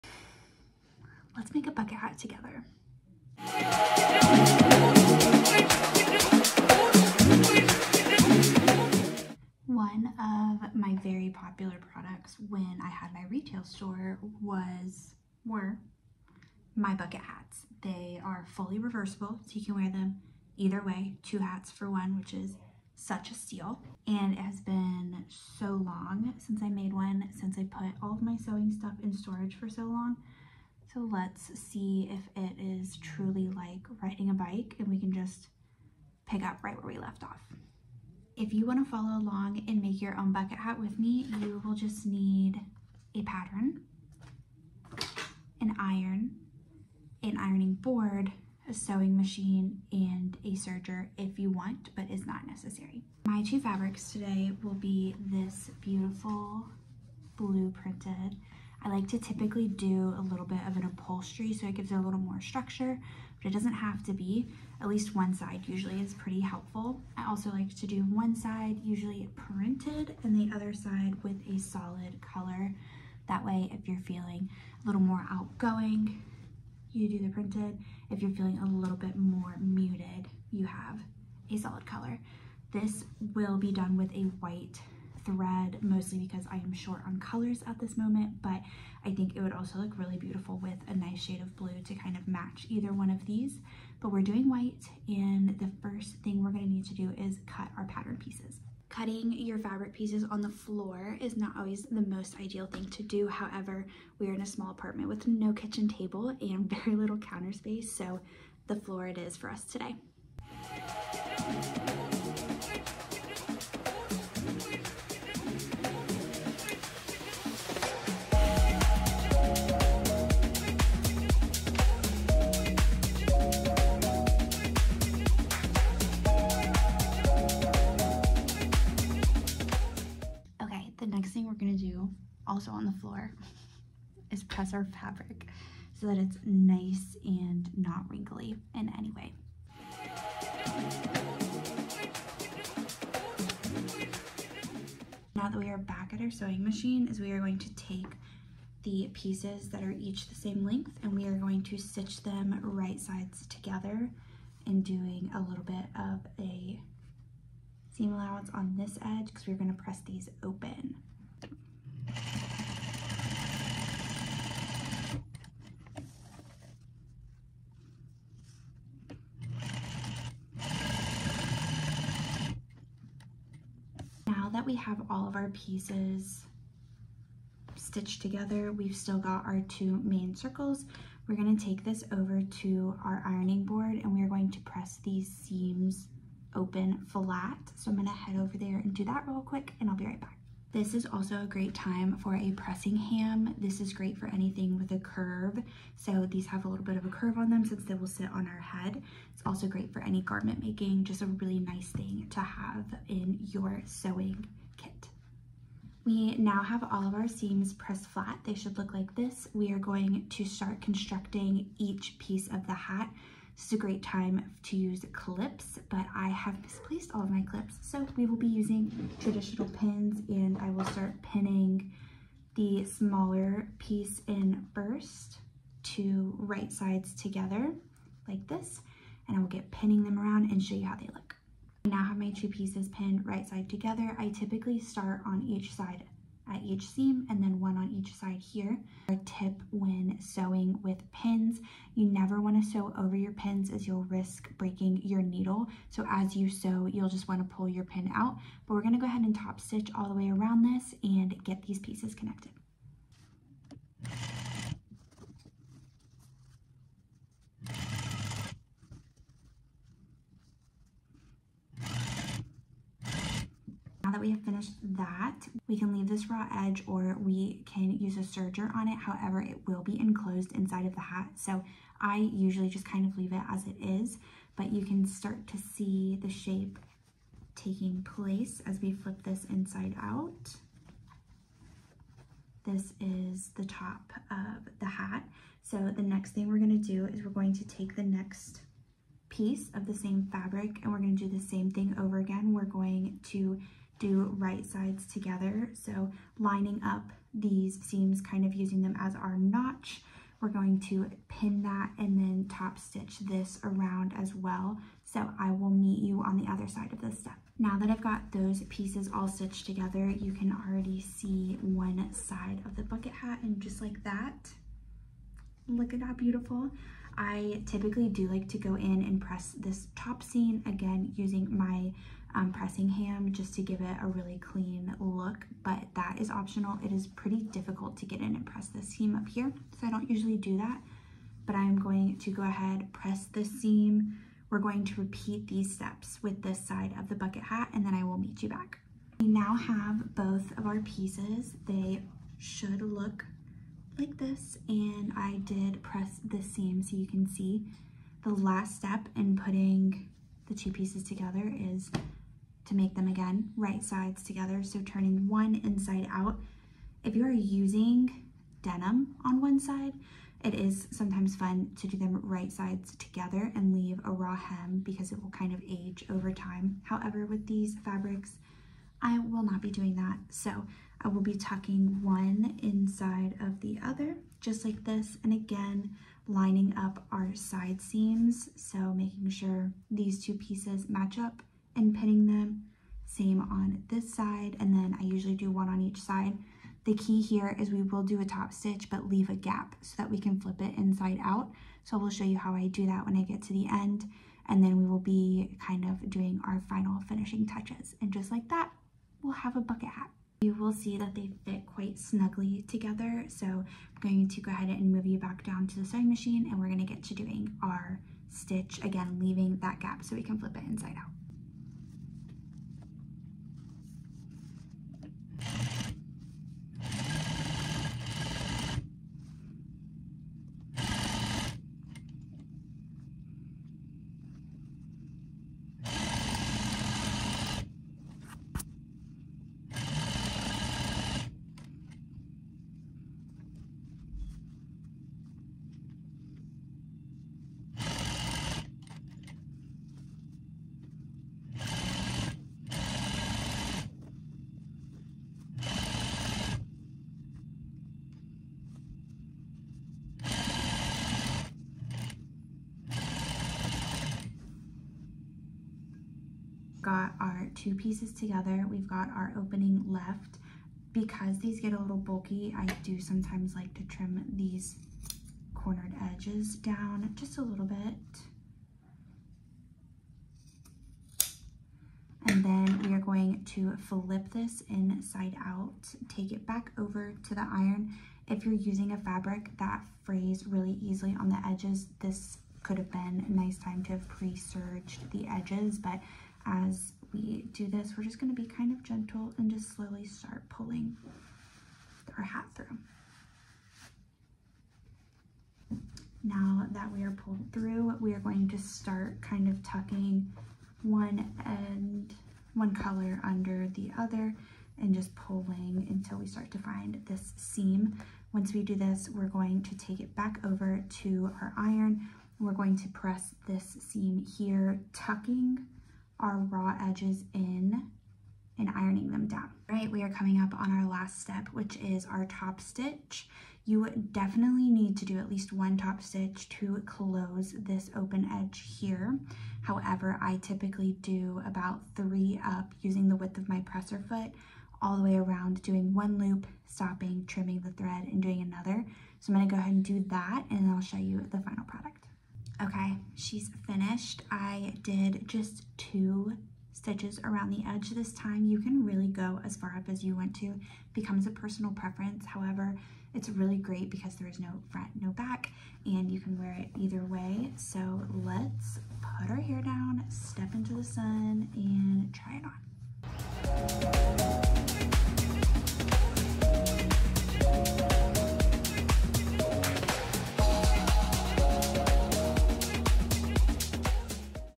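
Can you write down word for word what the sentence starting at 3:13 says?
This is great for anything with a curve.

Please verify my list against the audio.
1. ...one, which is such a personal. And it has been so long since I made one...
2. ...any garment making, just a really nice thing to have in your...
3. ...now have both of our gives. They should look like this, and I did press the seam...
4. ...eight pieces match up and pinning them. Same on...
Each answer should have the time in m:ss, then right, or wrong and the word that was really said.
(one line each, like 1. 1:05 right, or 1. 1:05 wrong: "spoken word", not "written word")
1. 0:21 wrong: "steal", not "personal"
2. 3:20 right
3. 5:39 wrong: "pieces", not "gives"
4. 6:20 wrong: "two", not "eight".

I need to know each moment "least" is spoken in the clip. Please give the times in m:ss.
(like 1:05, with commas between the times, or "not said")
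1:04, 8:45.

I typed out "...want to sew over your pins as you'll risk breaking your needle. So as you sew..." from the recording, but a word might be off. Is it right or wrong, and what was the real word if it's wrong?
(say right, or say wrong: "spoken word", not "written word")
right.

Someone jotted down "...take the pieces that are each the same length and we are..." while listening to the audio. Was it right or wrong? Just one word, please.
right.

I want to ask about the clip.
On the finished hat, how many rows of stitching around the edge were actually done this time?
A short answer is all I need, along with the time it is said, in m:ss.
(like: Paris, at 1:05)
2, at 9:05.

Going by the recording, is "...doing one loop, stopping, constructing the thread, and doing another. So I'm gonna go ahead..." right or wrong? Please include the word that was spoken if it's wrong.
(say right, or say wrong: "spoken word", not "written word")
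wrong: "trimming", not "constructing".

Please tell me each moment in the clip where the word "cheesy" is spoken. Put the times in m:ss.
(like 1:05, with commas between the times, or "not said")
not said.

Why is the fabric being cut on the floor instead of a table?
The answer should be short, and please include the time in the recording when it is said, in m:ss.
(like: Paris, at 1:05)
small apartment, at 1:44.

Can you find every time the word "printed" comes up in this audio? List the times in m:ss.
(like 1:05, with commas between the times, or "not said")
0:57, 1:09, 1:17.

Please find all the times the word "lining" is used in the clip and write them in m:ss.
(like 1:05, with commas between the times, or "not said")
4:56, 6:16.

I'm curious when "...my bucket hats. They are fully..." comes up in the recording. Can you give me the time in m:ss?
0:16.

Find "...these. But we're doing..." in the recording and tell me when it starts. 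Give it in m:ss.
1:33.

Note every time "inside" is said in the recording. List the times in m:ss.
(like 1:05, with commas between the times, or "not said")
4:30, 4:39, 5:55, 6:12, 6:30, 6:50, 7:54.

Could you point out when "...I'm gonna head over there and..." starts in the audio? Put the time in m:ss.
3:07.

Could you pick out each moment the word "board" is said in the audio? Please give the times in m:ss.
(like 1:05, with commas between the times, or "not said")
0:47, 3:03.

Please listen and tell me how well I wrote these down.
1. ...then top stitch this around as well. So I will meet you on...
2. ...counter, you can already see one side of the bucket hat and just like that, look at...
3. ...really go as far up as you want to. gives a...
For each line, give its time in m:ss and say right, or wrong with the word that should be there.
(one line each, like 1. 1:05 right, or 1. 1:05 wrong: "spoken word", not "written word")
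1. 5:02 right
2. 5:09 wrong: "together", not "counter"
3. 9:08 wrong: "becomes", not "gives".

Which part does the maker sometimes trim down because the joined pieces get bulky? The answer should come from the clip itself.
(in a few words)
cornered edges.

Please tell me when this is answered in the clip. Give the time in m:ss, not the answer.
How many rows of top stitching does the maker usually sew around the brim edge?
8:51.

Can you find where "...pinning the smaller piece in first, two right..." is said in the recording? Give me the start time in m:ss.
3:41.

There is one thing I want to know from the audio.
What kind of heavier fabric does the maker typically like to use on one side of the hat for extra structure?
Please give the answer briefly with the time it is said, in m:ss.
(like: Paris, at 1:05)
upholstery, at 1:00.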